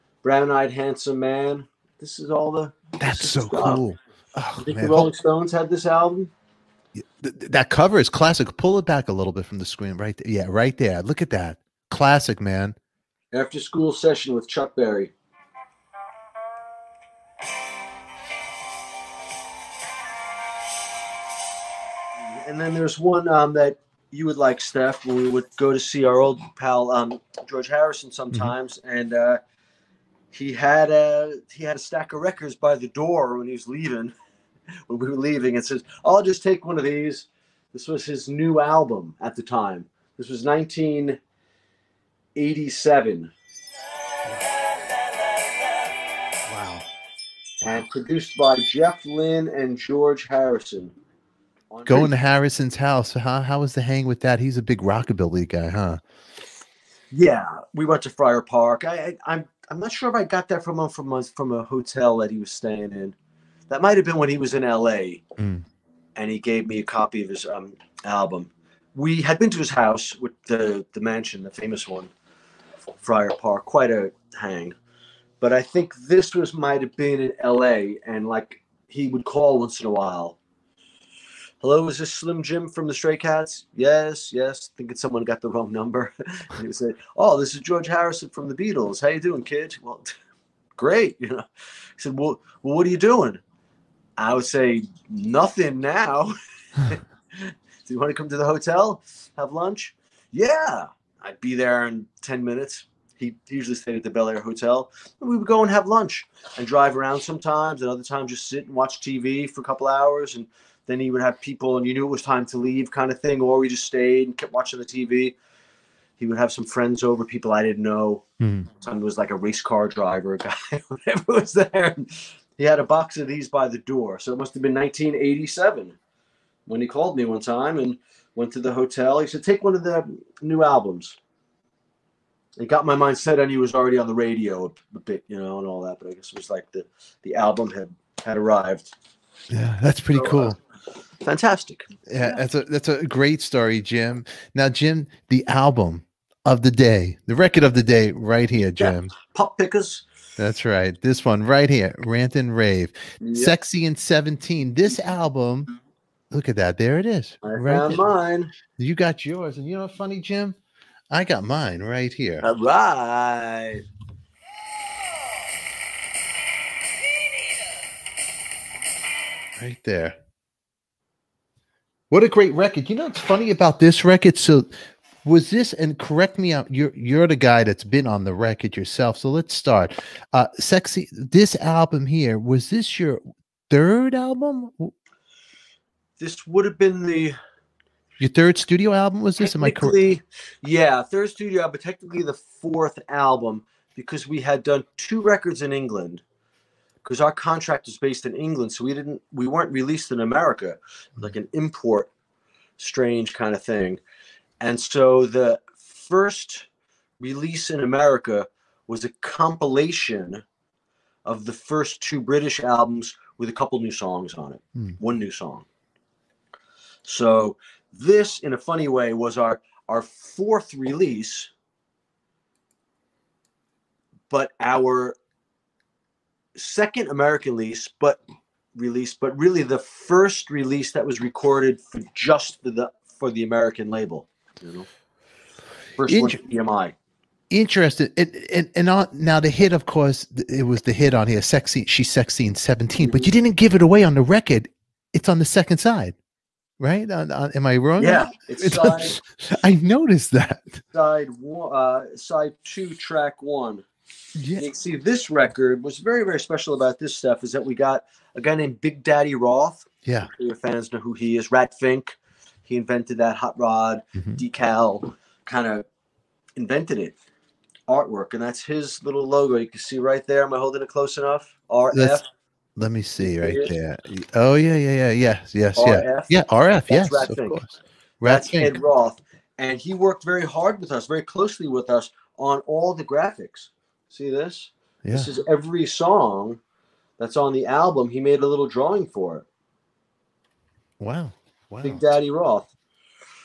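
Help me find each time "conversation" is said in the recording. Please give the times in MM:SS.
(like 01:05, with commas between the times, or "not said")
not said.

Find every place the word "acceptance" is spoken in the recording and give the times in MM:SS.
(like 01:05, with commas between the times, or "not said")
not said.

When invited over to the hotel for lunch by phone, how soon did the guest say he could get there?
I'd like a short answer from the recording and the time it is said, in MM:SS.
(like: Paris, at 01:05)
10 minutes, at 01:42.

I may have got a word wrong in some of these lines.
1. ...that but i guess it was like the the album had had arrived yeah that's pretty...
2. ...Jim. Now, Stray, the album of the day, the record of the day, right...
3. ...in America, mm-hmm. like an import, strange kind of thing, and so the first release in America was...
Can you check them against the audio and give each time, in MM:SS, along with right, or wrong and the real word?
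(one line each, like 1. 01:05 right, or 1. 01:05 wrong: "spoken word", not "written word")
1. 02:15 right
2. 02:23 wrong: "Jim", not "Stray"
3. 03:20 right.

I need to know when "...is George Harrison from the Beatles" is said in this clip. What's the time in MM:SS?
01:27.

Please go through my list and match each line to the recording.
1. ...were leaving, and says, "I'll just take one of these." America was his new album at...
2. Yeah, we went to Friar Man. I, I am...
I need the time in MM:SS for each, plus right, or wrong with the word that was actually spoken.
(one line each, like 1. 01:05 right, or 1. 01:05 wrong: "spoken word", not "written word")
1. 00:35 wrong: "This", not "America"
2. 00:57 wrong: "Park", not "Man".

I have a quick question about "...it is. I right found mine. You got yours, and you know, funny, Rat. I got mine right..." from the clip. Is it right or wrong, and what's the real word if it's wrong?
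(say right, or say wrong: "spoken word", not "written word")
wrong: "Jim", not "Rat".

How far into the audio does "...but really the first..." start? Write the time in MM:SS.
03:49.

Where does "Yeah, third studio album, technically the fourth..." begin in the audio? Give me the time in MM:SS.
03:10.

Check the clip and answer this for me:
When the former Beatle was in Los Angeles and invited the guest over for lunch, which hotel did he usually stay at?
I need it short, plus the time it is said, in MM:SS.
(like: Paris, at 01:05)
Bel Air Hotel, at 01:44.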